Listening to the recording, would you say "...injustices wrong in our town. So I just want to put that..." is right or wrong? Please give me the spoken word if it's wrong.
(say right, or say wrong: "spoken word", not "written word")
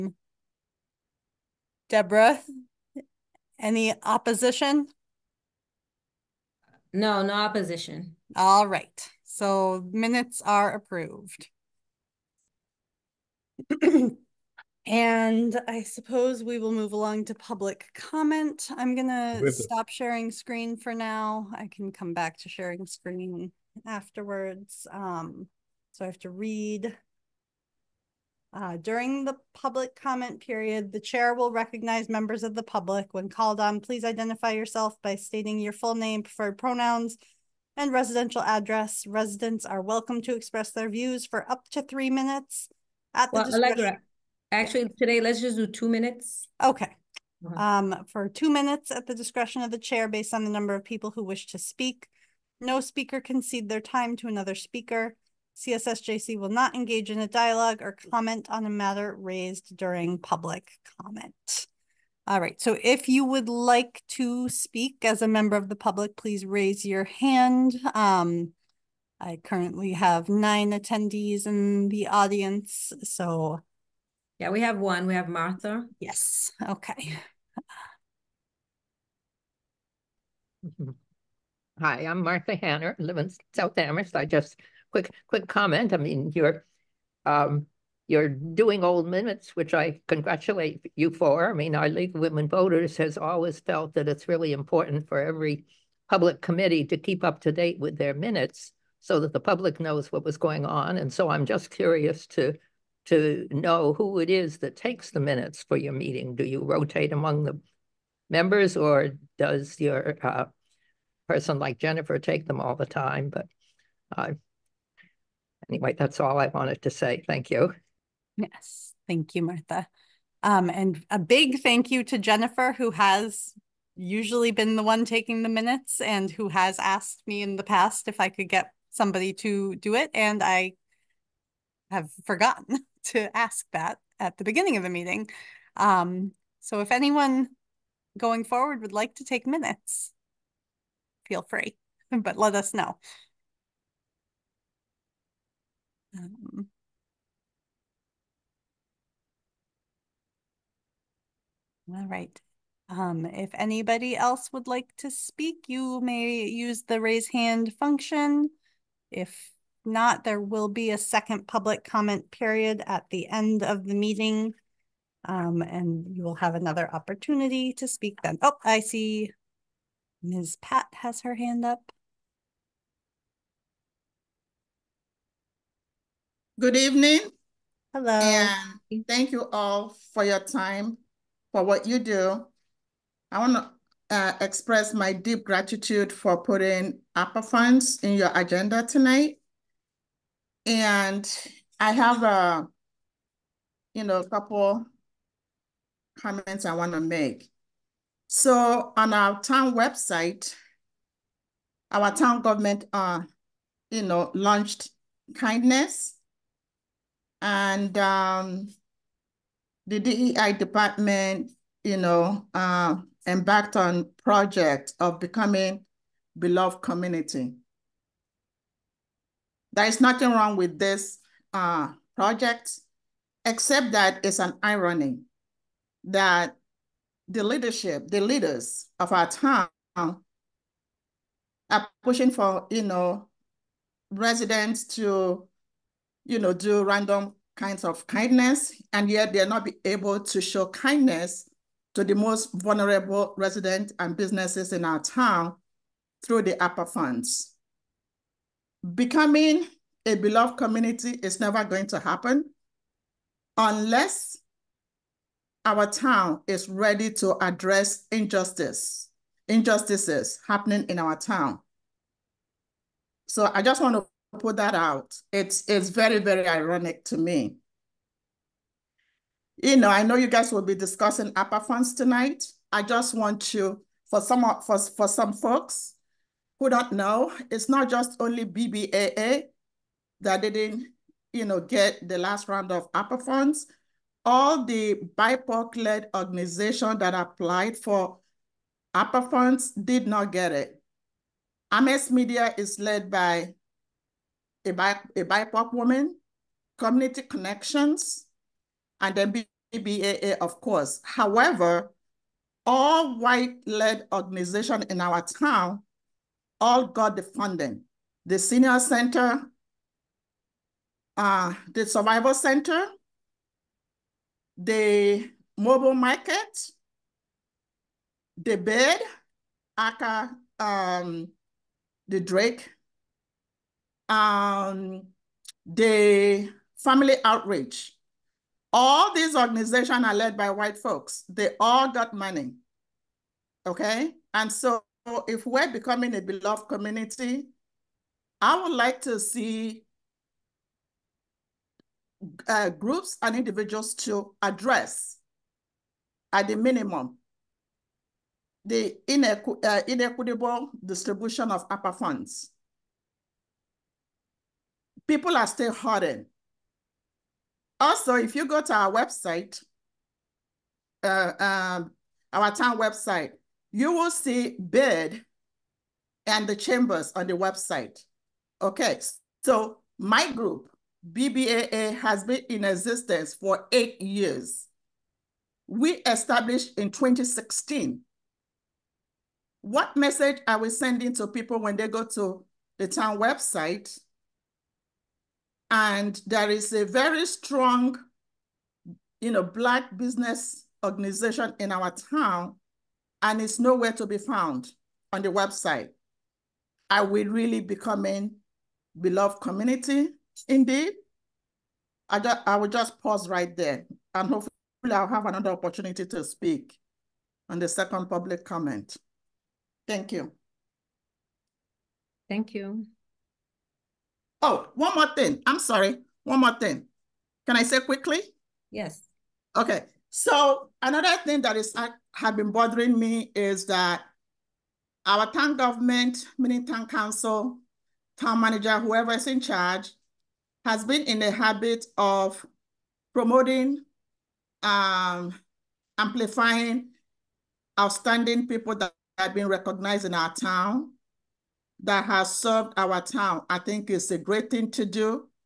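wrong: "happening", not "wrong".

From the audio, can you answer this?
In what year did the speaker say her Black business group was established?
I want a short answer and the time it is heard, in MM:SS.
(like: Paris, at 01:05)
2016, at 06:16.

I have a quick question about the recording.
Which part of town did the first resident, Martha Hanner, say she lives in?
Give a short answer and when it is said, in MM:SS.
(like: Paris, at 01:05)
South Amherst, at 01:23.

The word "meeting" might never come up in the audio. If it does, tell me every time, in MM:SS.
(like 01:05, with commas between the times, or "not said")
01:45, 02:14, 02:43.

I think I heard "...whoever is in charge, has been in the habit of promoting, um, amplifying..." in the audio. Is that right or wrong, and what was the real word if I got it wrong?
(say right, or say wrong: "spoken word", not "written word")
right.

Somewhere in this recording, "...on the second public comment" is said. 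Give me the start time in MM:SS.
06:47.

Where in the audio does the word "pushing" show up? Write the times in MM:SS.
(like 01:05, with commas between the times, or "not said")
03:52.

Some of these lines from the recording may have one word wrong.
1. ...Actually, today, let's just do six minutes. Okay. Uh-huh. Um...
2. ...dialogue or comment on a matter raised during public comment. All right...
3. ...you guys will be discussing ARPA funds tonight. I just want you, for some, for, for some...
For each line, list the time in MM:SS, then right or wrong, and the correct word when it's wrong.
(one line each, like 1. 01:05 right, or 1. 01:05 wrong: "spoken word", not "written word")
1. 00:44 wrong: "two", not "six"
2. 00:57 right
3. 04:30 right.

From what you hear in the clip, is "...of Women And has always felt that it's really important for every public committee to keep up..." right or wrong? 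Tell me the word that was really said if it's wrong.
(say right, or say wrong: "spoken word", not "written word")
wrong: "Voters", not "And".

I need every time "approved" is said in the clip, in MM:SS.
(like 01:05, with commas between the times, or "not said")
00:10.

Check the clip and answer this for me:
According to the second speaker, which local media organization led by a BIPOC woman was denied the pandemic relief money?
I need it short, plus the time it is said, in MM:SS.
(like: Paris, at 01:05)
Amherst Media, at 04:51.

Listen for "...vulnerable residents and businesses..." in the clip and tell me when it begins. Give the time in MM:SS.
04:02.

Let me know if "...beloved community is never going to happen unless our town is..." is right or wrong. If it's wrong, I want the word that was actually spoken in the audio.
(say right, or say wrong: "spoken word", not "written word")
right.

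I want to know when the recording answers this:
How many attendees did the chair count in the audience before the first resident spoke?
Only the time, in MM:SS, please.
01:10.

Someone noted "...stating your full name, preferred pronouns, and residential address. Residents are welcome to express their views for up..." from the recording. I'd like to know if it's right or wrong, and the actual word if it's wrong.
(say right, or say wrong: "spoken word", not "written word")
right.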